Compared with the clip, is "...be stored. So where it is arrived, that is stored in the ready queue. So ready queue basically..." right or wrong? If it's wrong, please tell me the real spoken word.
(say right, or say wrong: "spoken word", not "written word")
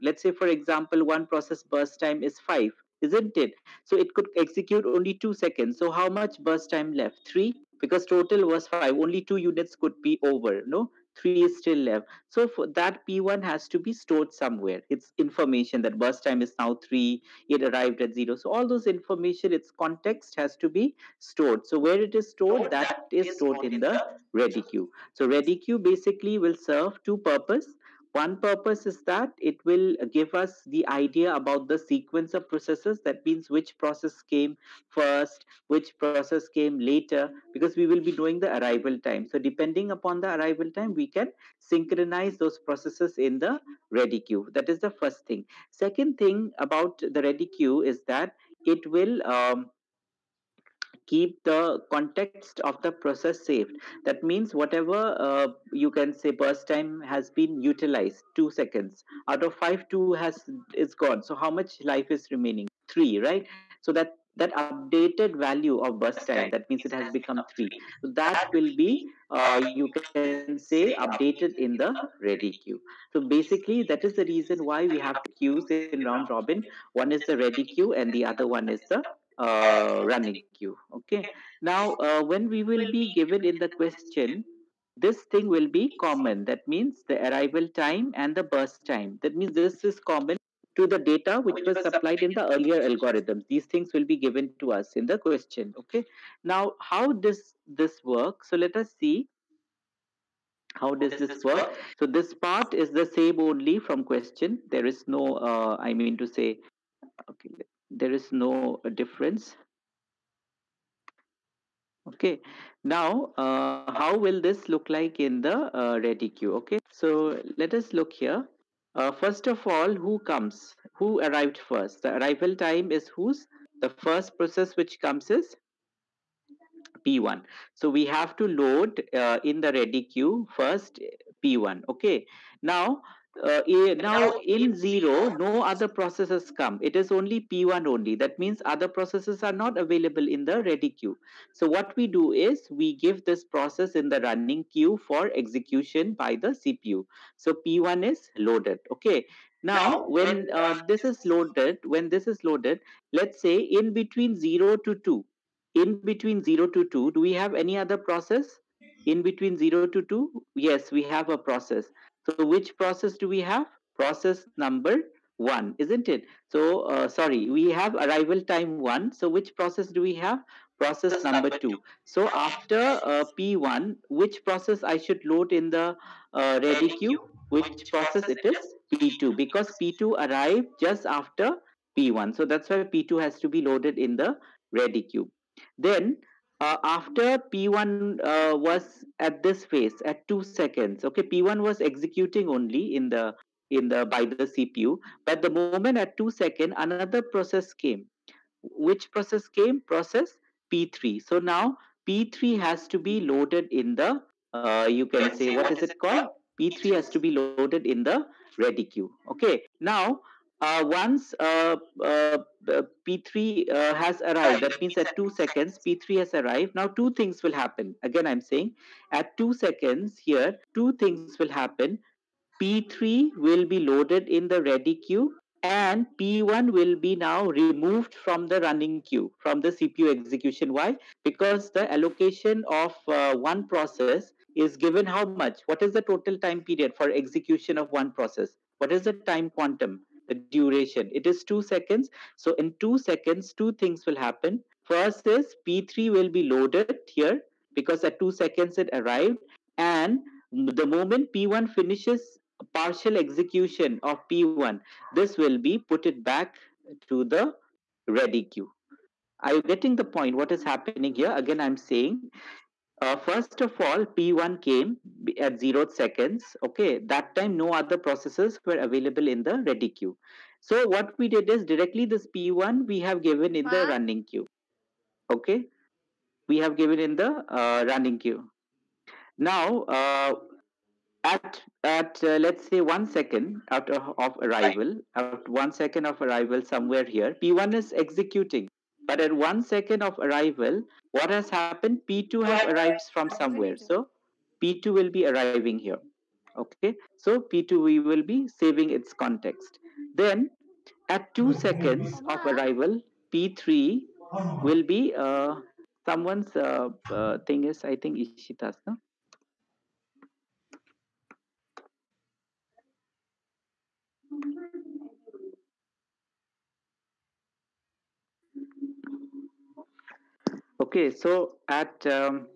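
wrong: "stored", not "arrived".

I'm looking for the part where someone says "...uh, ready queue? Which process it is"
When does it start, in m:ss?
2:56.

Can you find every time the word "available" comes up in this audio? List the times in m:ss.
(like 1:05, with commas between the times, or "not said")
2:19, 4:28.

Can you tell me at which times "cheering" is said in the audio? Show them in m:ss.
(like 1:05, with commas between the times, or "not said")
not said.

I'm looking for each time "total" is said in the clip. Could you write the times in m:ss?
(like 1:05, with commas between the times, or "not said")
0:08, 3:56.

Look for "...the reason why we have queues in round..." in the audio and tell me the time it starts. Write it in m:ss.
1:14.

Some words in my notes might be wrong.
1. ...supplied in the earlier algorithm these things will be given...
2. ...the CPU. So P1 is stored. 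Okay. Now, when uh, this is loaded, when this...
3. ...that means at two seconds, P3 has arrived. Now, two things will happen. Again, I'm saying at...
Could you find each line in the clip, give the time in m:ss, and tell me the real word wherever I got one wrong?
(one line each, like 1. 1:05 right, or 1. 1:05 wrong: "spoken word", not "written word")
1. 1:31 right
2. 2:26 wrong: "loaded", not "stored"
3. 3:34 right.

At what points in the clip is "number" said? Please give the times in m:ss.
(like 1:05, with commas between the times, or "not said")
2:44, 2:51.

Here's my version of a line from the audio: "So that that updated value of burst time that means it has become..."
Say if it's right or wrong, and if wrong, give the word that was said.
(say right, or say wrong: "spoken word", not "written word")
right.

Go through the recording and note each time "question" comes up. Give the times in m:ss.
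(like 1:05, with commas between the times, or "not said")
1:23, 1:35, 1:44.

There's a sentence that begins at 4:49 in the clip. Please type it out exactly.
But at one second of arrival, what has happened?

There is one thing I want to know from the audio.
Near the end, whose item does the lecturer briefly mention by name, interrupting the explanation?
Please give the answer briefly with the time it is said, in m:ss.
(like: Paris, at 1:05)
Ishita, at 5:08.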